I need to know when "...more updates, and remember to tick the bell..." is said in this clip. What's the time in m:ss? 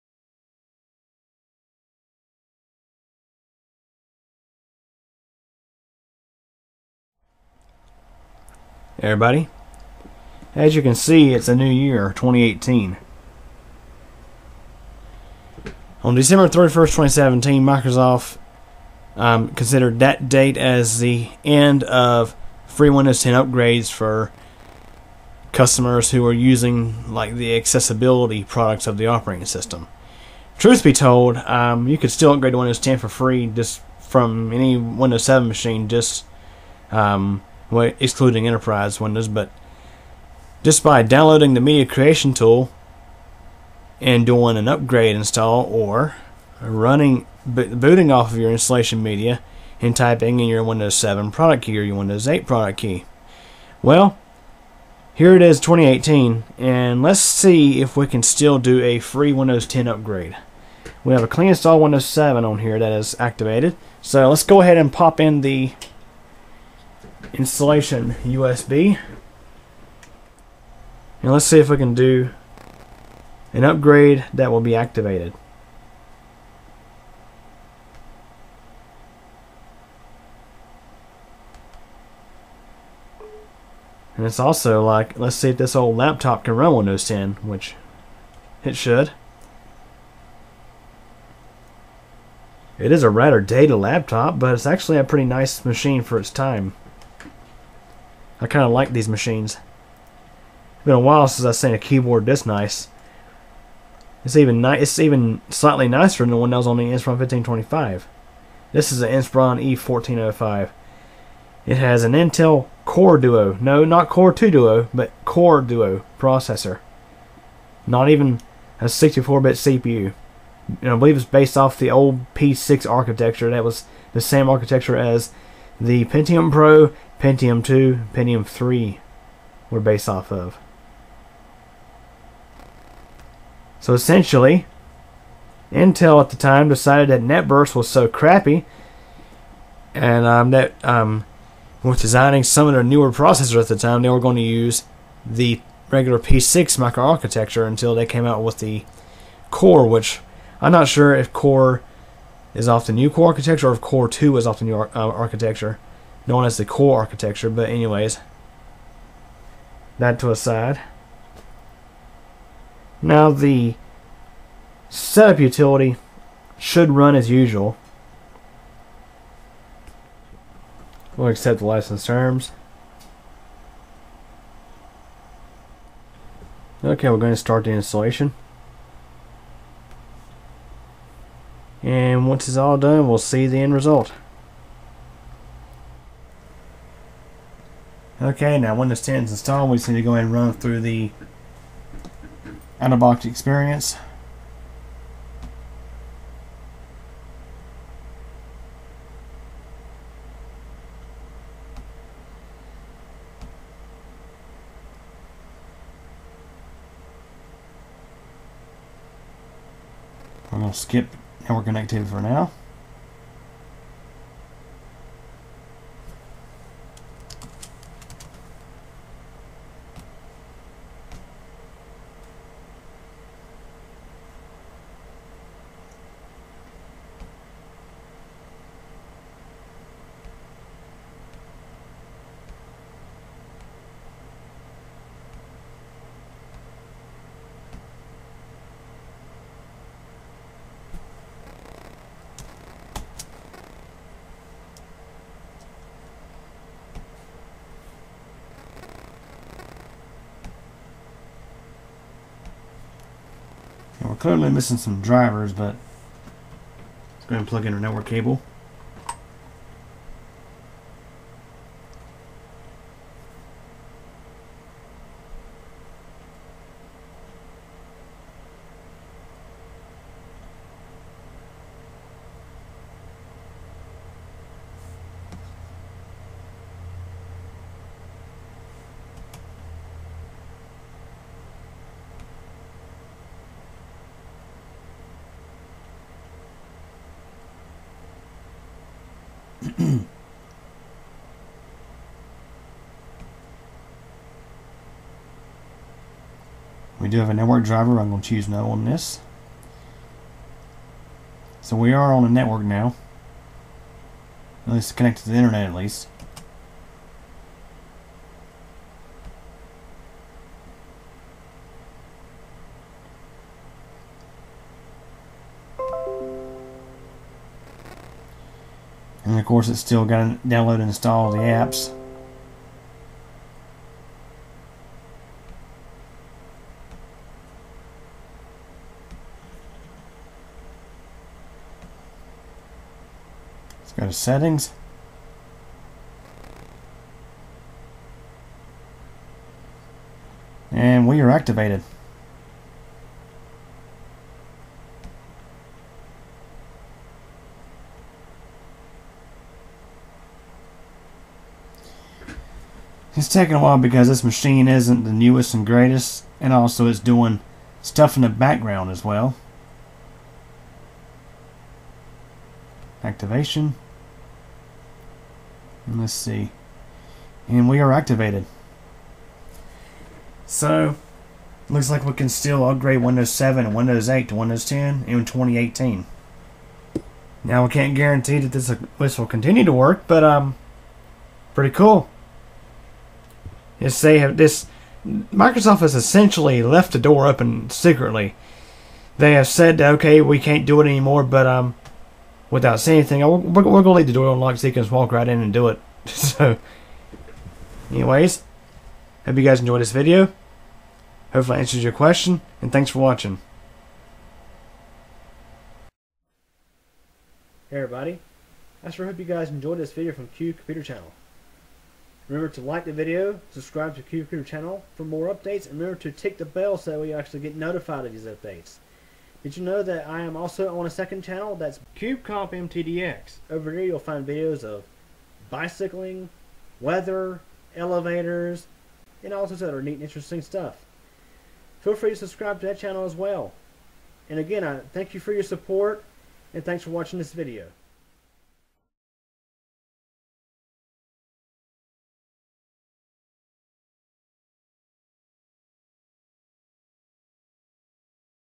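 6:55.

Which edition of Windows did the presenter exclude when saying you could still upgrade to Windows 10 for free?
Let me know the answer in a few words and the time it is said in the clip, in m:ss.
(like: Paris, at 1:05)
Enterprise, at 0:38.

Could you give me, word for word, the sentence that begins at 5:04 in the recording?
At least connected to the internet at least.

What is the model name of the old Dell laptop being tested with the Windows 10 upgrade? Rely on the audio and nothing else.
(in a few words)
Inspiron E1405.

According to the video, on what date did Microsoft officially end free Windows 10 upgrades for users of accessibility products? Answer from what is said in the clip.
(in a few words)
December 31st, 2017.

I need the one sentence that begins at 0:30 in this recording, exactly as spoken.
Truth be told, um, you could still upgrade to Windows 10 for free just from any Windows 7 machine.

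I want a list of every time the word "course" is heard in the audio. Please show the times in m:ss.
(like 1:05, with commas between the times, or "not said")
5:19.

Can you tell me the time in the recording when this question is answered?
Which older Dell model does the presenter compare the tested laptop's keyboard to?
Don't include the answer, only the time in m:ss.
1:46.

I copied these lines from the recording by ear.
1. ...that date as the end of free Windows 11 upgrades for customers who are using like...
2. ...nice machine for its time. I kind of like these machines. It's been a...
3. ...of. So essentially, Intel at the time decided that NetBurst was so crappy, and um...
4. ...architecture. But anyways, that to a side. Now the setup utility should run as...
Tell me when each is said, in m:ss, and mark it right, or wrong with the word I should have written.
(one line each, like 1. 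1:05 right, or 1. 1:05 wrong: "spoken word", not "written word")
1. 0:19 wrong: "10", not "11"
2. 1:35 right
3. 2:10 right
4. 2:36 right.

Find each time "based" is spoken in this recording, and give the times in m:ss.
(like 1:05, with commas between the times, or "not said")
2:01, 2:09.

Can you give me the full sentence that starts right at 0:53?
Well, here it is 2018 and let's see if we can still do a free Windows 10 upgrade.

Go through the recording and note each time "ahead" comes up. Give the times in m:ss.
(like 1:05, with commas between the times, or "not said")
1:04, 3:10, 4:17.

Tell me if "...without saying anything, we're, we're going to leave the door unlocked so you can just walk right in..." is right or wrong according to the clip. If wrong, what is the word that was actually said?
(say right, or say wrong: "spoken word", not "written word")
right.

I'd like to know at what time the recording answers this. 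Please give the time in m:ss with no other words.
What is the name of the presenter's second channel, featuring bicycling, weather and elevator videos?
7:01.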